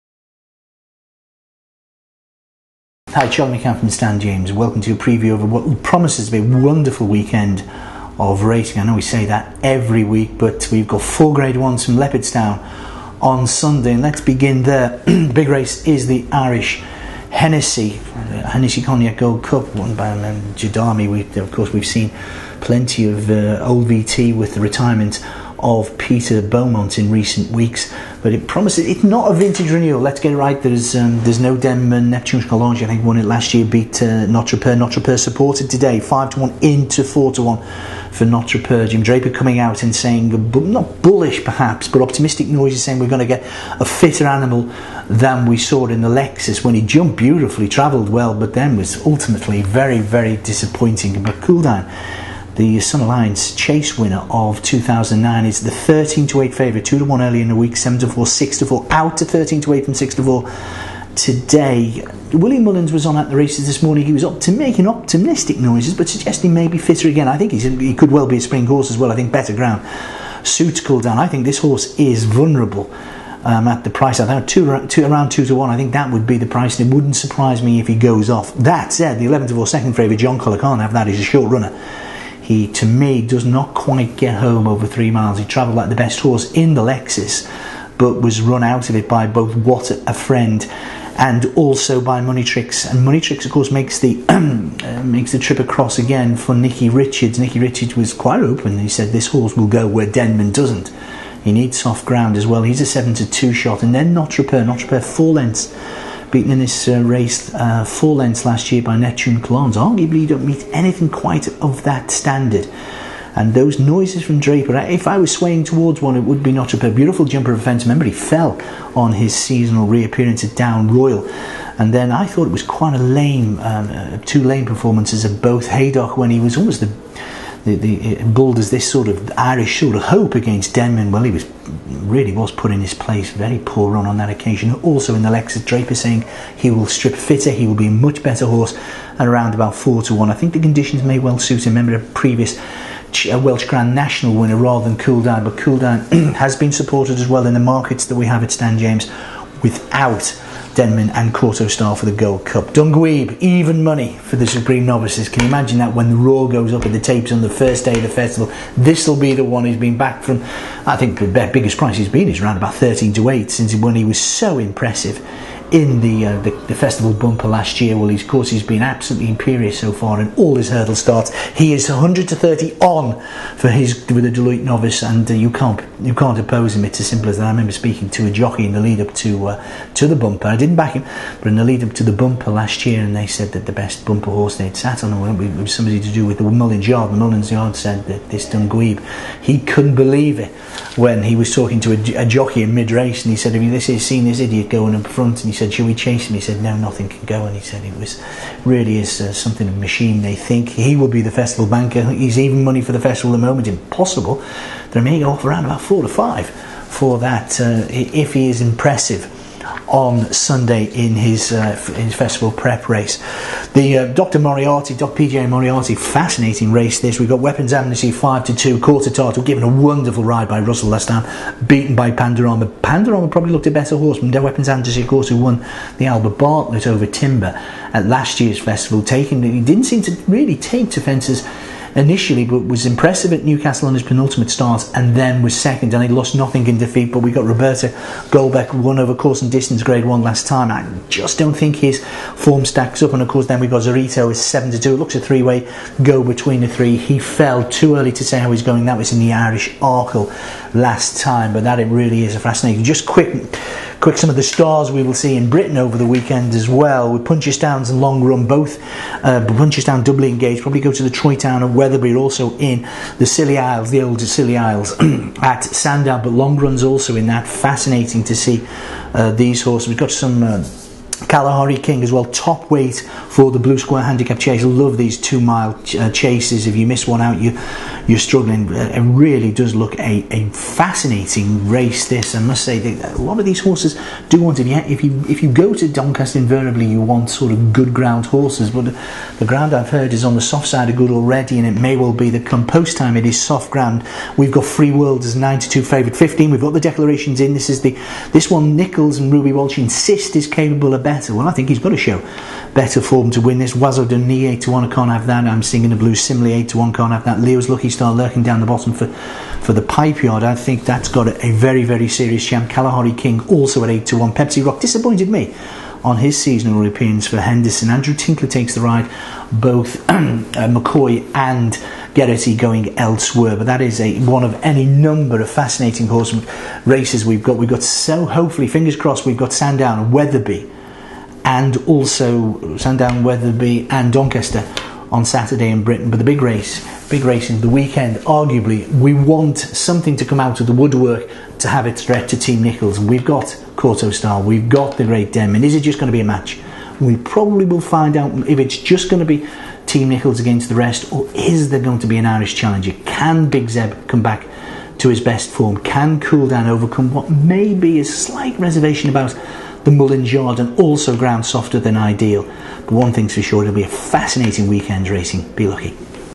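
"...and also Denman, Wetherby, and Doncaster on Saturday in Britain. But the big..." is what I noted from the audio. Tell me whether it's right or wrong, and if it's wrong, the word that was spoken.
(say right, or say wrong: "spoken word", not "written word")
wrong: "Sandown", not "Denman".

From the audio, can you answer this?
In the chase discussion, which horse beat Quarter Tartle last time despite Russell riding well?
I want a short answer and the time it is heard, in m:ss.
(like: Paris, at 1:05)
Pandorama, at 3:41.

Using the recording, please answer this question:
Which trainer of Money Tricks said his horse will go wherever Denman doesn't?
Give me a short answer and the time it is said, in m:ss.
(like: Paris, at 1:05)
Nicky Richards, at 1:37.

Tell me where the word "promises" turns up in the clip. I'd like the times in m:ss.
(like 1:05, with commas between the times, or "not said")
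0:05, 0:28.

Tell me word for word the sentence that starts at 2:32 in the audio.
Dunguib, even money for the Supreme Novices.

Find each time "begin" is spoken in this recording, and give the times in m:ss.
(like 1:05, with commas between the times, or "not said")
0:14.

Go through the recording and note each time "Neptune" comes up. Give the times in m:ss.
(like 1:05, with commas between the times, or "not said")
0:32, 1:48.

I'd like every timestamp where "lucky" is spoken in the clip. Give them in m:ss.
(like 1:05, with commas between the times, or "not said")
5:07, 6:05.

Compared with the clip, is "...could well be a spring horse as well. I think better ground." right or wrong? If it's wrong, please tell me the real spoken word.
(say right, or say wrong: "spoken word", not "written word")
right.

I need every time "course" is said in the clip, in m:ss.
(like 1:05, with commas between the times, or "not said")
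0:21, 1:33, 2:48, 3:45, 3:59, 4:03.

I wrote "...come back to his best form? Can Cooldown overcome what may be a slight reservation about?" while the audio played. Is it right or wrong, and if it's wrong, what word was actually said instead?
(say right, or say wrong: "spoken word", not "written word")
right.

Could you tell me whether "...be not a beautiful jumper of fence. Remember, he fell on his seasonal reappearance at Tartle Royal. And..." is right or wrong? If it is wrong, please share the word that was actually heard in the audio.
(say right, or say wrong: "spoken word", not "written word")
wrong: "Down", not "Tartle".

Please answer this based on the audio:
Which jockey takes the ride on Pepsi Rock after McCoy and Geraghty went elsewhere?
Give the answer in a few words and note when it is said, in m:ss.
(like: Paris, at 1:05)
Andrew Tinkler, at 5:17.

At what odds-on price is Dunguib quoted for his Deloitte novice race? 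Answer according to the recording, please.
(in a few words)
100 to 30 on.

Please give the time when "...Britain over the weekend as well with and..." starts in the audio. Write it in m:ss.
4:15.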